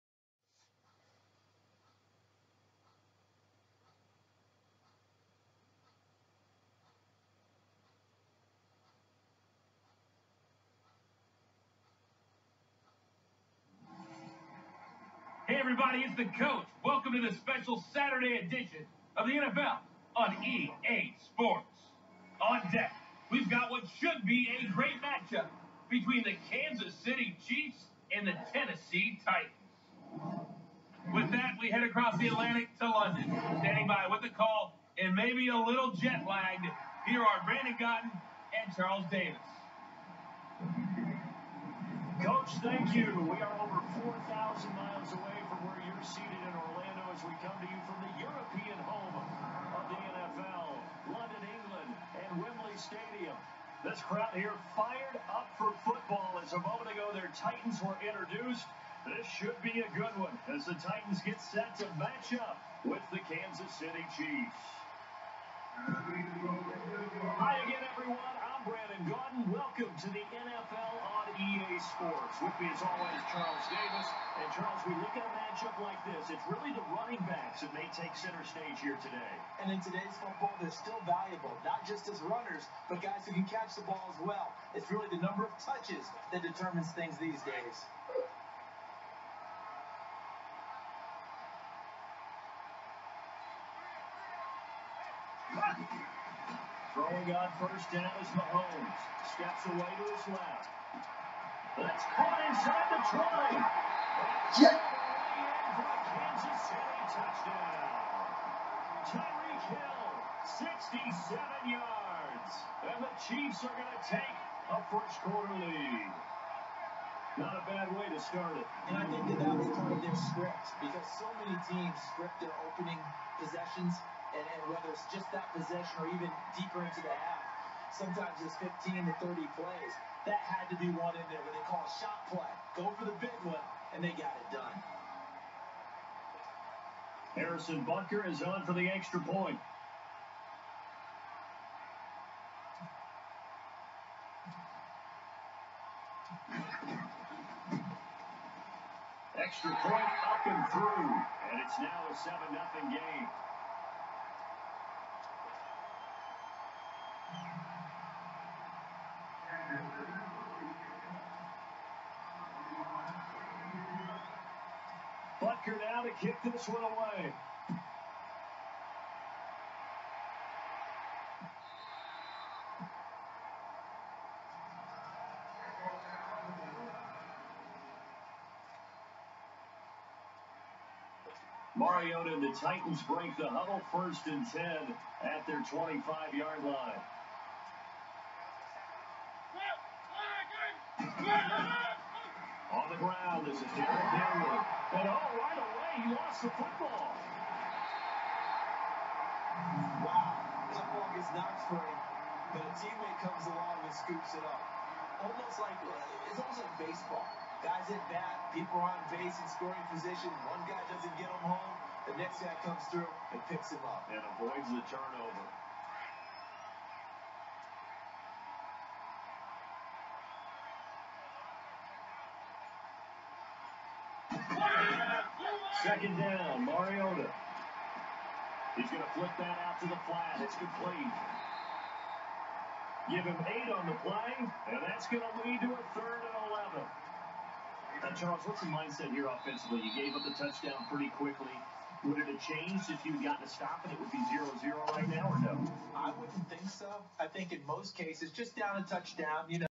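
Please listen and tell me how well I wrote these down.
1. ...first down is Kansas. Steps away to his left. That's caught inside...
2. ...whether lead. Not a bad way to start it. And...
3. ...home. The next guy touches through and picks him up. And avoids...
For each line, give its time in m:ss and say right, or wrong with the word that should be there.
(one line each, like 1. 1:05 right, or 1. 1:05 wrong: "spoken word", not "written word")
1. 1:37 wrong: "Mahomes", not "Kansas"
2. 1:55 wrong: "quarter", not "whether"
3. 3:31 wrong: "comes", not "touches".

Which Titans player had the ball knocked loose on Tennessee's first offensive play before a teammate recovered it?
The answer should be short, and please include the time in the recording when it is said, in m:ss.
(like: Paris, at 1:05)
Jared Dinwiddie, at 3:13.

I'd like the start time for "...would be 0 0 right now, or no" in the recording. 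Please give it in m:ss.
4:03.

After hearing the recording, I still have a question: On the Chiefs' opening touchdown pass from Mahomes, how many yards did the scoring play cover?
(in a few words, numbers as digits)
67 yards.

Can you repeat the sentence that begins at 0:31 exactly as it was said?
With that, we head across the Atlantic to London.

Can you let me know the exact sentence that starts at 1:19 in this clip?
And in today's football, they're still valuable, not just as runners, but guys who can catch the ball as well.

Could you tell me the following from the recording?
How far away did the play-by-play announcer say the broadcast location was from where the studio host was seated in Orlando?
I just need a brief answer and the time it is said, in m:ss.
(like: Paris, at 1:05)
over 4,000 miles, at 0:43.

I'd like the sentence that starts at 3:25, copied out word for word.
Almost like, uh, it's almost like baseball.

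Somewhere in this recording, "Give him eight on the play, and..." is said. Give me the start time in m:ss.
3:53.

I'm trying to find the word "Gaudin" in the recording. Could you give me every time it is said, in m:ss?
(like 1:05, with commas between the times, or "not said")
0:37, 1:09.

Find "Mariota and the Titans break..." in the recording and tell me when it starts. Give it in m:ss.
3:01.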